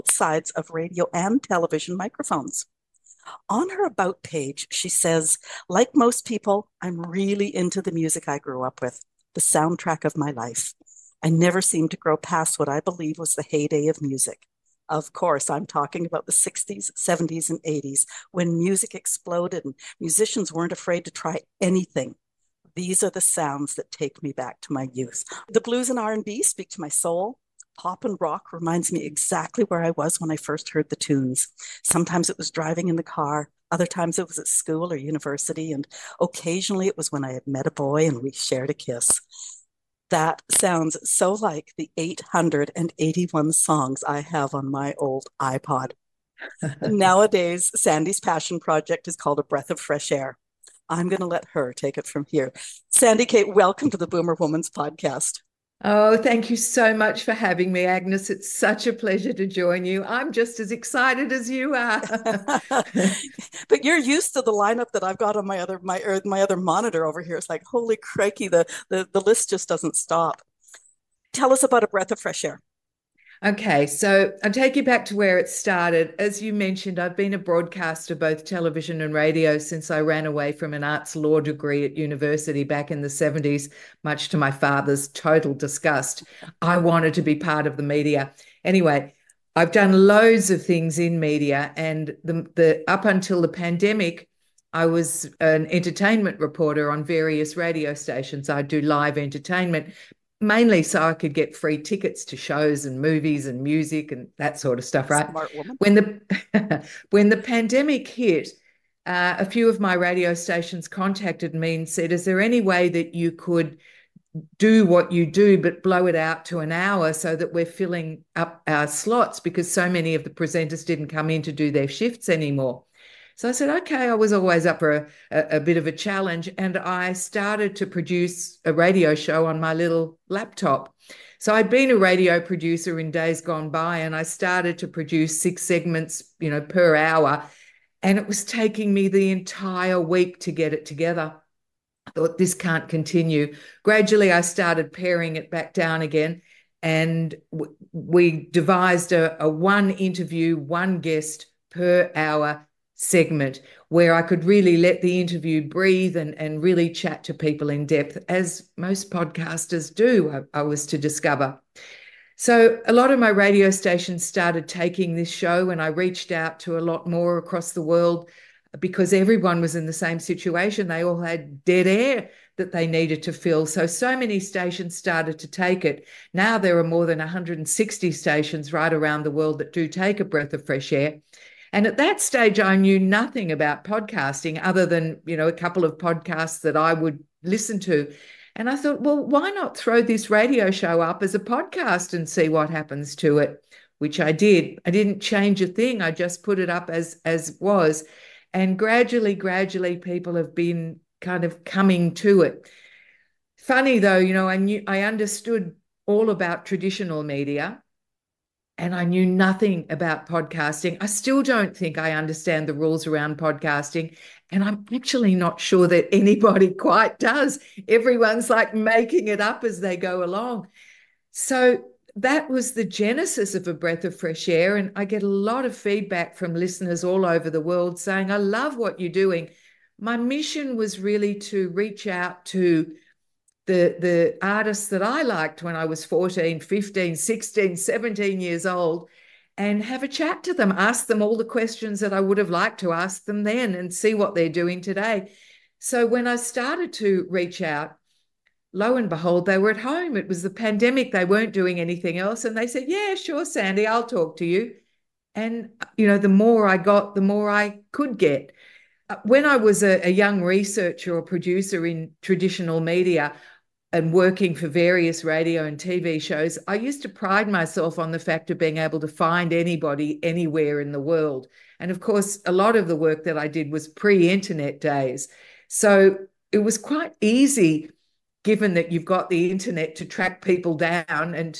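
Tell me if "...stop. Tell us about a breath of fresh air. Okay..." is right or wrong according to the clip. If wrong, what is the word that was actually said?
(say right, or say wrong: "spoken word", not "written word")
right.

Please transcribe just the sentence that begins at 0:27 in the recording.
Pop and rock reminds me exactly where I was when I first heard the tunes.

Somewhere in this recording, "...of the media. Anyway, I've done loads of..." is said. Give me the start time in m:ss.
1:27.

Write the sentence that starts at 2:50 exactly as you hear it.
They all had dead air that they needed to fill.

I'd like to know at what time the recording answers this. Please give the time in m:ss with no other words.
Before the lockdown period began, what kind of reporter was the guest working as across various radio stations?
1:35.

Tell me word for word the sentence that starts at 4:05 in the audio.
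So when I started to reach out, lo and behold, they were at home.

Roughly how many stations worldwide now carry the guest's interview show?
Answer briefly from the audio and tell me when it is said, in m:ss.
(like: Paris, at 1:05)
More than 160, at 2:56.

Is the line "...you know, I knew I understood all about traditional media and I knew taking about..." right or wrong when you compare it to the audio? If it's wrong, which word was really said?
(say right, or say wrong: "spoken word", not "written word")
wrong: "nothing", not "taking".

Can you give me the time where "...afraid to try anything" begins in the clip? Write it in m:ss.
0:20.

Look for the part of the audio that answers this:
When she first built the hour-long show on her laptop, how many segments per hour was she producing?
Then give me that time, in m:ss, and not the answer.
2:15.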